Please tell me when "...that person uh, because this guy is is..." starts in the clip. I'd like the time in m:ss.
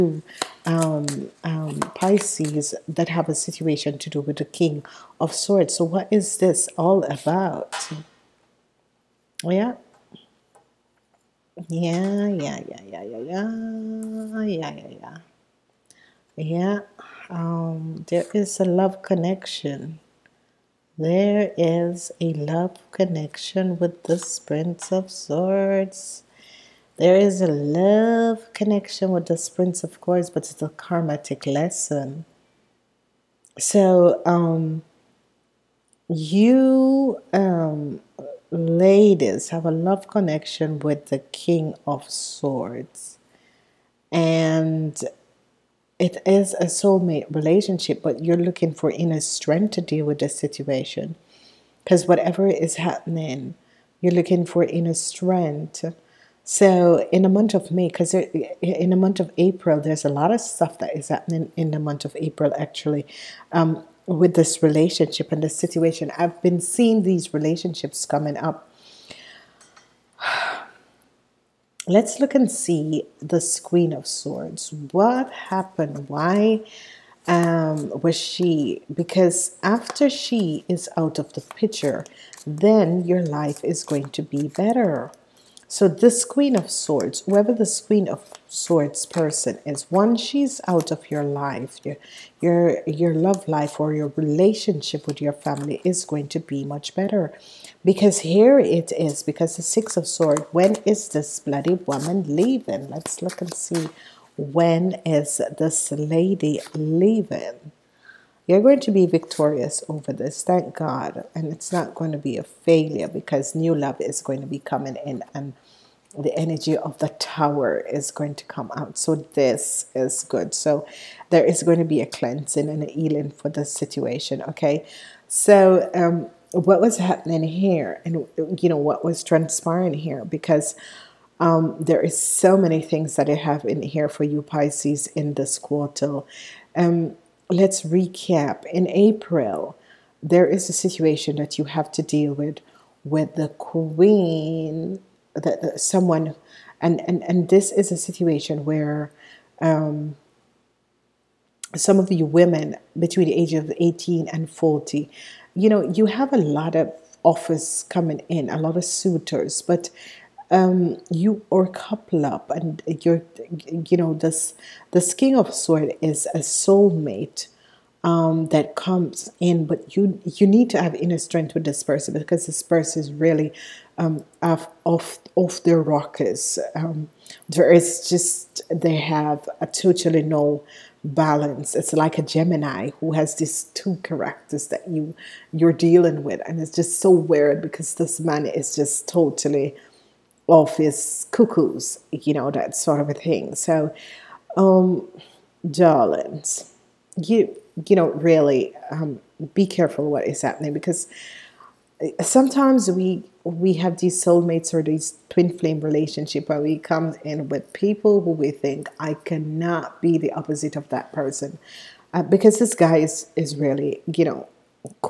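3:30.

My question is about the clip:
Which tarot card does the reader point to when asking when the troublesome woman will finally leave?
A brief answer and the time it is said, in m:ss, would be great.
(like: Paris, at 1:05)
Six of Swords, at 1:39.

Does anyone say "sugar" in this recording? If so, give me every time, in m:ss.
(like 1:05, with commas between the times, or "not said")
not said.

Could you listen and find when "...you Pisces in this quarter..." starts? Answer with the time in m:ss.
2:14.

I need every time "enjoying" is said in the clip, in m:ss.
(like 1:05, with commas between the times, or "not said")
not said.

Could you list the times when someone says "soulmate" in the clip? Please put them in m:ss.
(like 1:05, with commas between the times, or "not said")
0:46, 2:46, 3:24.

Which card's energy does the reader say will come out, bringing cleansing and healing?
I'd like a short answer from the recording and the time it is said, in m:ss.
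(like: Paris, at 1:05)
The Tower, at 1:57.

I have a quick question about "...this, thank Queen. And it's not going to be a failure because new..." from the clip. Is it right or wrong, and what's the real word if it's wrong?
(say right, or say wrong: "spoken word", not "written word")
wrong: "God", not "Queen".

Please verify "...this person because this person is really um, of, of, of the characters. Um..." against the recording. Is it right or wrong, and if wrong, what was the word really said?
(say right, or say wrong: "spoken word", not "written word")
wrong: "rockers", not "characters".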